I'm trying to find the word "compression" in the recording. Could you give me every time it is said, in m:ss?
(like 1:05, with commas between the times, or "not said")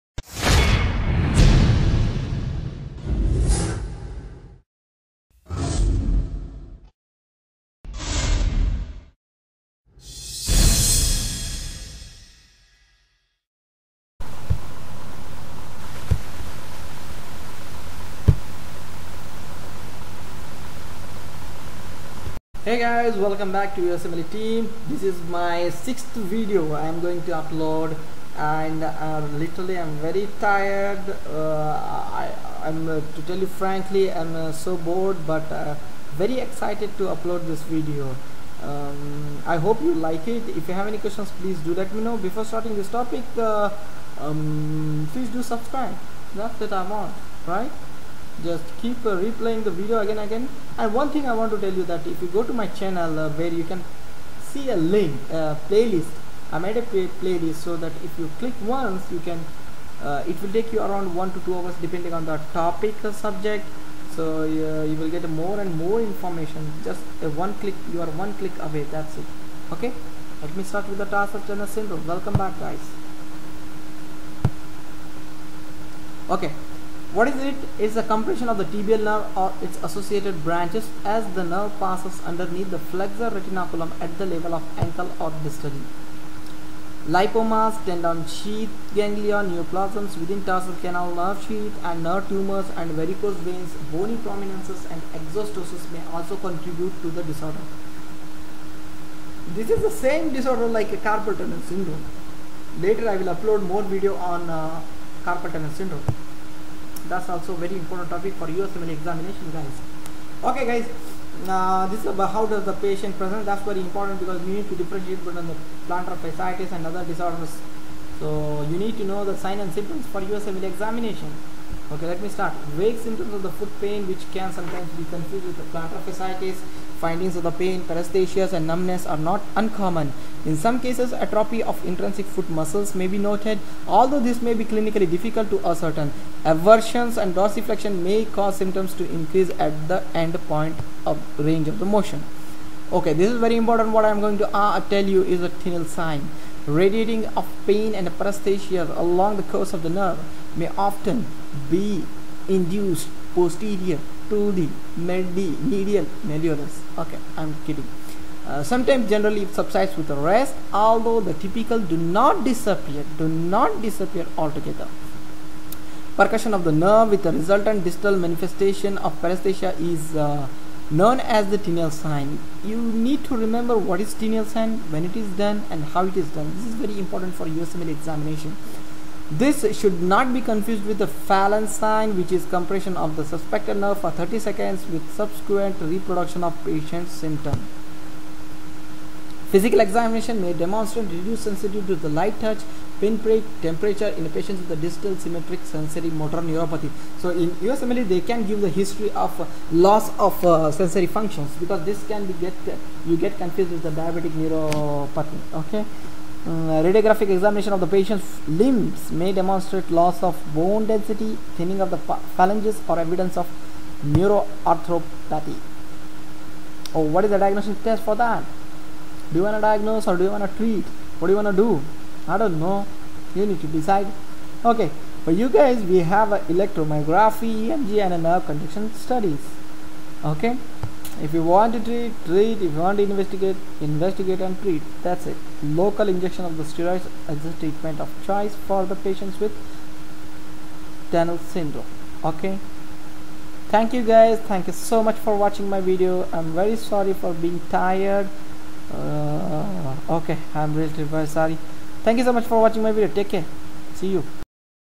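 1:18, 3:02.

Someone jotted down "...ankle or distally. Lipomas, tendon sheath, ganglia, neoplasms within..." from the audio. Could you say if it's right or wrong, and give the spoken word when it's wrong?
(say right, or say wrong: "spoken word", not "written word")
right.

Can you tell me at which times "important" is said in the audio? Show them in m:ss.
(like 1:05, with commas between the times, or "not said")
1:47, 1:53, 2:23, 2:57.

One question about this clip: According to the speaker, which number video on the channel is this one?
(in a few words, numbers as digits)
6th.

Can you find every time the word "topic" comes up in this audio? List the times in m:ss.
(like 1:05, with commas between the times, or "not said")
0:42, 1:02, 1:48.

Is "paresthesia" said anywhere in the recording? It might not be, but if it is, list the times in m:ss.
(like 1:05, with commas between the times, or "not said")
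2:07, 2:28, 2:49.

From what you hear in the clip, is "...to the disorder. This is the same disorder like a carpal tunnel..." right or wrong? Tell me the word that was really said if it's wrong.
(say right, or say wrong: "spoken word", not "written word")
right.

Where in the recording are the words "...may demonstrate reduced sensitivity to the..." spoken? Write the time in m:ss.
3:10.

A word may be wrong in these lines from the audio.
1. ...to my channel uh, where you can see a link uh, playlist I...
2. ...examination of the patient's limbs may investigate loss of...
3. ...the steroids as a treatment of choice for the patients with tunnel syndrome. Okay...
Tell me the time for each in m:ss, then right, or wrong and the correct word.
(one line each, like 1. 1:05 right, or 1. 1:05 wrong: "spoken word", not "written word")
1. 0:52 right
2. 3:27 wrong: "demonstrate", not "investigate"
3. 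3:56 right.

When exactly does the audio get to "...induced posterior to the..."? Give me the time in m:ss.
2:32.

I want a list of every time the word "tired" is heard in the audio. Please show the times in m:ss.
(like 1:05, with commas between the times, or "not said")
0:30, 4:07.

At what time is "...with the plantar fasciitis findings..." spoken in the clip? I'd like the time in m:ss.
2:05.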